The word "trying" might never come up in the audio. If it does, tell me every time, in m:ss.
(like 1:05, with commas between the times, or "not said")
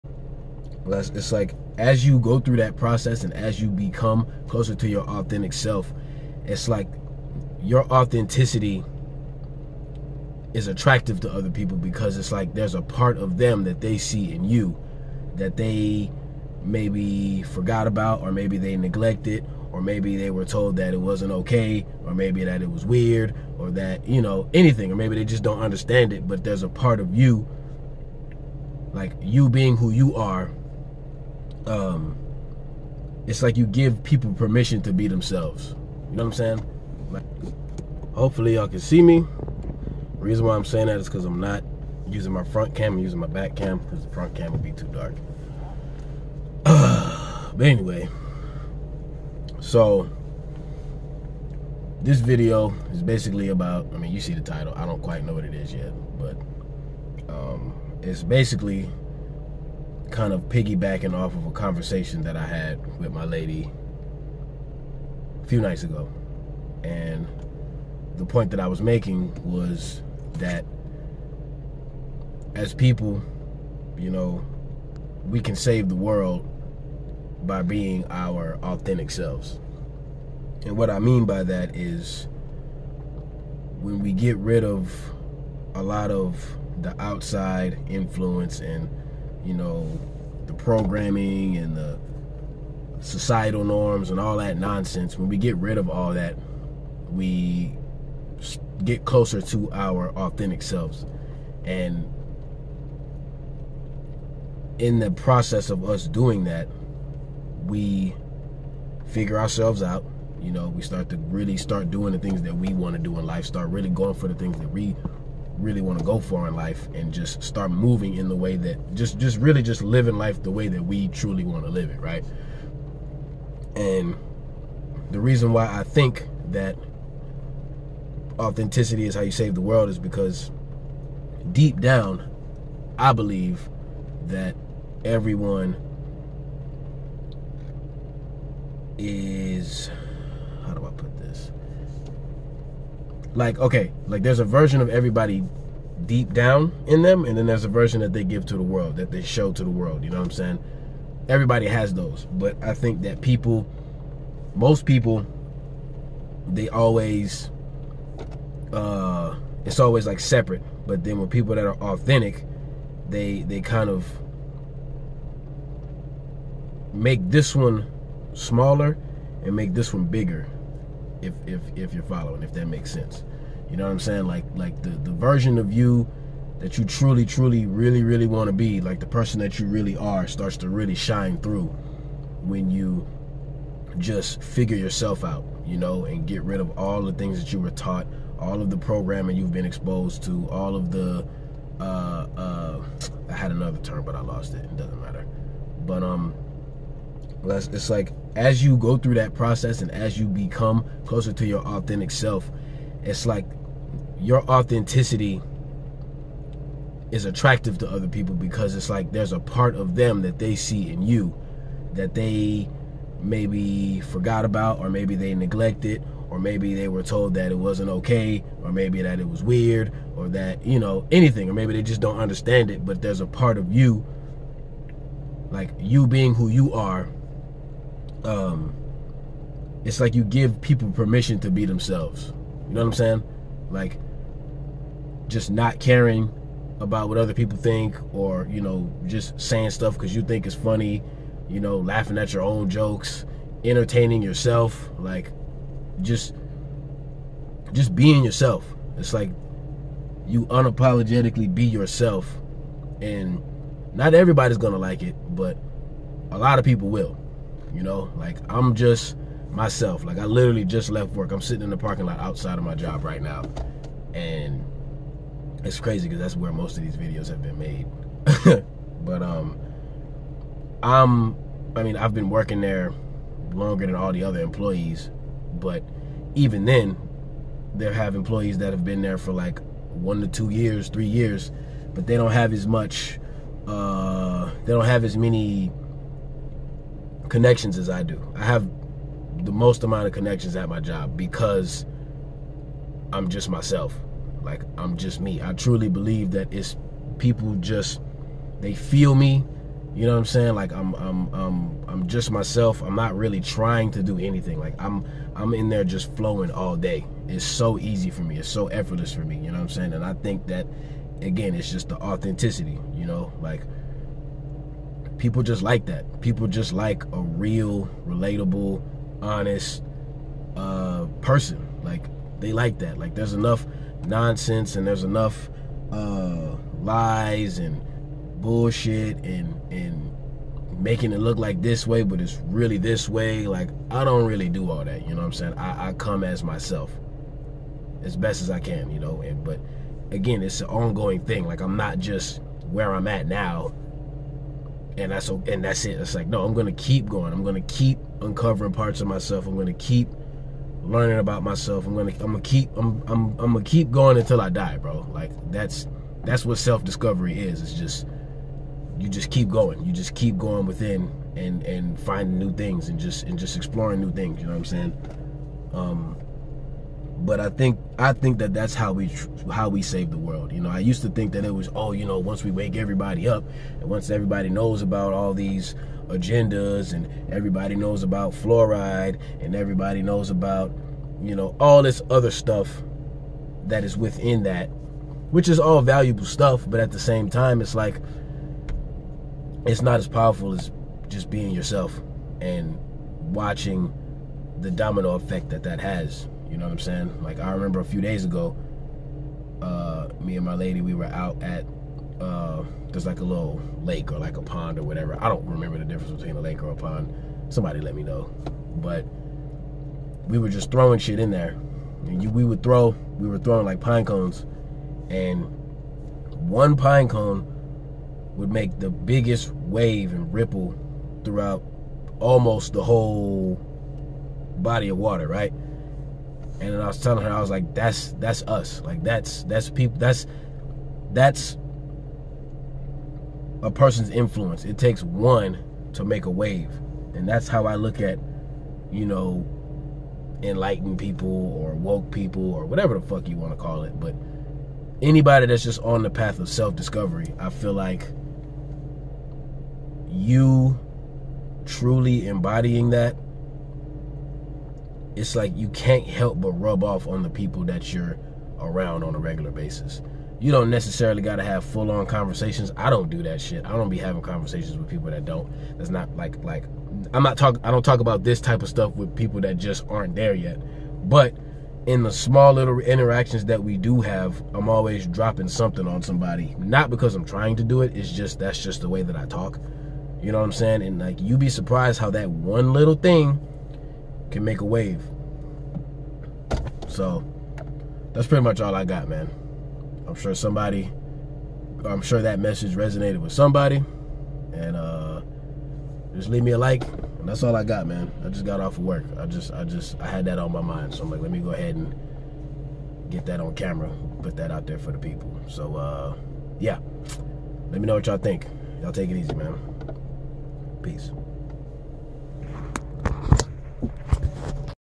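5:03, 7:57.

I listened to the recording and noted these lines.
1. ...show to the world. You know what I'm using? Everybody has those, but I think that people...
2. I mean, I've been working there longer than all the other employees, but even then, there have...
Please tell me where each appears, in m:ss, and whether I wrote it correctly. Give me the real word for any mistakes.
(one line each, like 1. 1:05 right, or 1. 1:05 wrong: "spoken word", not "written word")
1. 2:29 wrong: "saying", not "using"
2. 4:31 right.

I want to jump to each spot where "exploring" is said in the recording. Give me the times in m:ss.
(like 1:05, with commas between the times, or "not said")
6:03.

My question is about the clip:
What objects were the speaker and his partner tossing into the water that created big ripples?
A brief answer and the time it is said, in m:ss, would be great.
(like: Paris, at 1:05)
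Pine cones, at 6:53.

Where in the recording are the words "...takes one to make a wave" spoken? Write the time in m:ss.
7:14.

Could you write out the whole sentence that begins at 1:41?
And in the process of us doing that, we figure ourselves out.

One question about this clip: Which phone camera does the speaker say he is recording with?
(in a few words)
Back cam.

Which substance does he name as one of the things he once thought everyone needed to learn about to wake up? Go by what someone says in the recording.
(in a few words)
Fluoride.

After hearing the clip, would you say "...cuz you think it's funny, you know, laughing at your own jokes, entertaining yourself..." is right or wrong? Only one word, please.
right.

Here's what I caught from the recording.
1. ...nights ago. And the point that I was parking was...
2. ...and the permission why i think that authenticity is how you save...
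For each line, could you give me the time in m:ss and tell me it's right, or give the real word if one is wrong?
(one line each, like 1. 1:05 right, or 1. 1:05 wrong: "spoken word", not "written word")
1. 1:05 wrong: "making", not "parking"
2. 2:03 wrong: "reason", not "permission".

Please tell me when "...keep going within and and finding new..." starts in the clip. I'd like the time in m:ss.
6:00.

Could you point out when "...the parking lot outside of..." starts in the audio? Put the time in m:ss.
4:21.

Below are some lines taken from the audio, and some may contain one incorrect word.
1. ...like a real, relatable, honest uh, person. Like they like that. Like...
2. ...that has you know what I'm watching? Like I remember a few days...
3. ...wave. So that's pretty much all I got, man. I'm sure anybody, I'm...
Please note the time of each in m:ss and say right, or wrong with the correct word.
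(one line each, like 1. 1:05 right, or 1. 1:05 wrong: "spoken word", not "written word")
1. 5:16 right
2. 6:35 wrong: "saying", not "watching"
3. 8:04 wrong: "somebody", not "anybody".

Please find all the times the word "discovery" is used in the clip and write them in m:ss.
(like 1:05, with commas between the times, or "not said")
5:56, 7:26.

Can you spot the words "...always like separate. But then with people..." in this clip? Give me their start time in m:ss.
2:39.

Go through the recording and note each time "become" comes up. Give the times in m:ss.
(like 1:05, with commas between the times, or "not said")
0:03, 3:20.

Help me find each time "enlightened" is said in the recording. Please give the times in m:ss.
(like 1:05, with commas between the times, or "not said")
7:20.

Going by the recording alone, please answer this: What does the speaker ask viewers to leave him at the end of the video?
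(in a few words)
A like.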